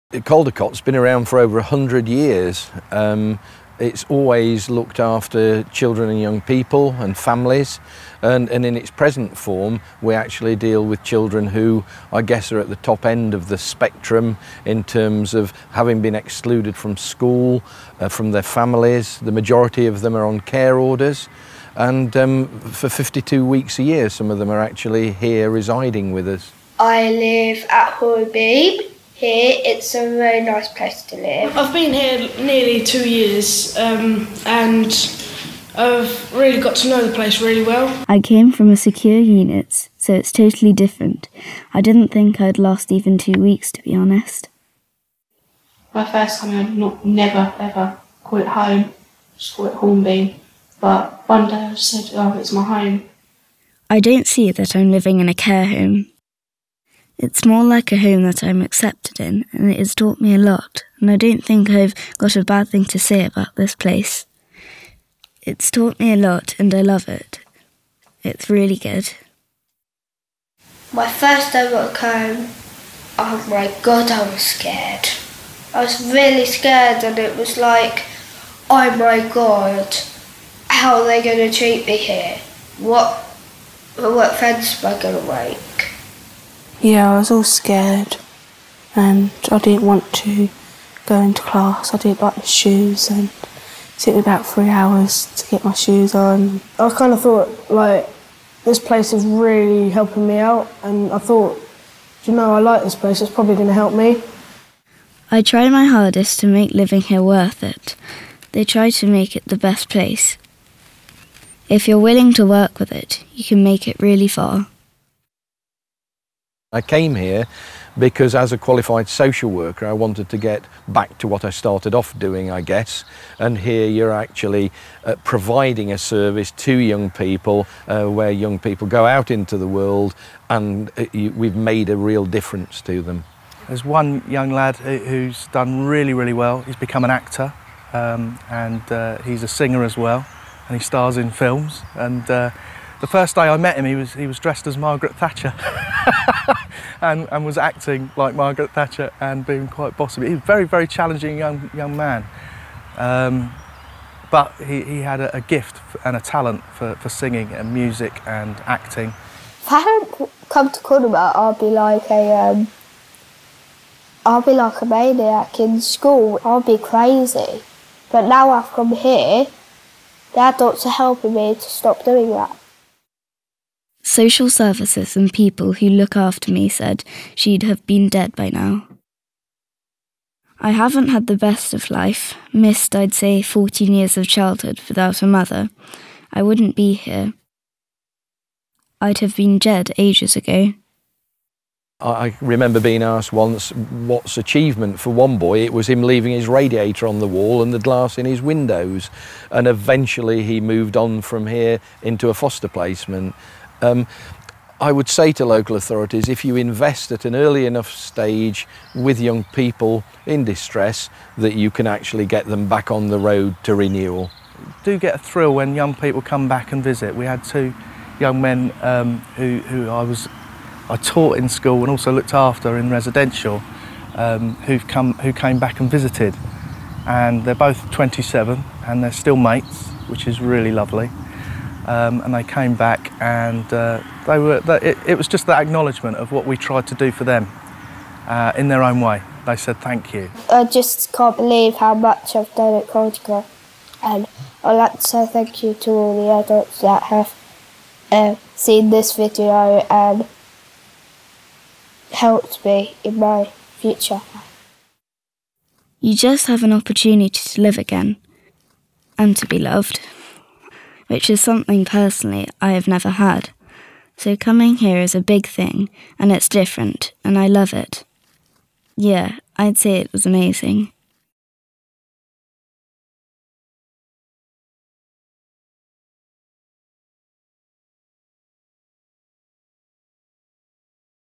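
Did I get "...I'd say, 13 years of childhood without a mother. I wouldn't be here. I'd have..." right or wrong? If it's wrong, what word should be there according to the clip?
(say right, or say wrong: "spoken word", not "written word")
wrong: "14", not "13".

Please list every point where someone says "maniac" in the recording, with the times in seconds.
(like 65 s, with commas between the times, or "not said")
164 s.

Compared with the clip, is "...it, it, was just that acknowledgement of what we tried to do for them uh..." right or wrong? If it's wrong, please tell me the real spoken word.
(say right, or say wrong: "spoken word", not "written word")
right.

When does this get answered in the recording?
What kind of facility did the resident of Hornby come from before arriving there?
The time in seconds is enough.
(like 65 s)
38 s.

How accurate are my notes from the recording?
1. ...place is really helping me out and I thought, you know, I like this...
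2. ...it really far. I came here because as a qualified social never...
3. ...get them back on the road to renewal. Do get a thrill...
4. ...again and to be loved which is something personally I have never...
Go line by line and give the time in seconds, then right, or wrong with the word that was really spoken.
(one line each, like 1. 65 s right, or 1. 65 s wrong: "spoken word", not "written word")
1. 98 s right
2. 113 s wrong: "worker", not "never"
3. 212 s right
4. 257 s right.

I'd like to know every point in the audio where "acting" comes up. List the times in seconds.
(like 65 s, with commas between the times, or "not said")
147 s, 158 s.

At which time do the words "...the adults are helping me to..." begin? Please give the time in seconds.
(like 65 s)
170 s.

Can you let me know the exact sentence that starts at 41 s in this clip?
I didn't think I'd last even two weeks, to be honest.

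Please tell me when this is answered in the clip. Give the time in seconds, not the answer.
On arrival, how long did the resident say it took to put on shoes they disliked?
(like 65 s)
94 s.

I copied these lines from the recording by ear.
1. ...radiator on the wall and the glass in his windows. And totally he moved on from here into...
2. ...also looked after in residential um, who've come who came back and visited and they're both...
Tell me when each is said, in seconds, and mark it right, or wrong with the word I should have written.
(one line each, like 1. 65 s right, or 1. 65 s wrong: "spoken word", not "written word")
1. 196 s wrong: "eventually", not "totally"
2. 221 s right.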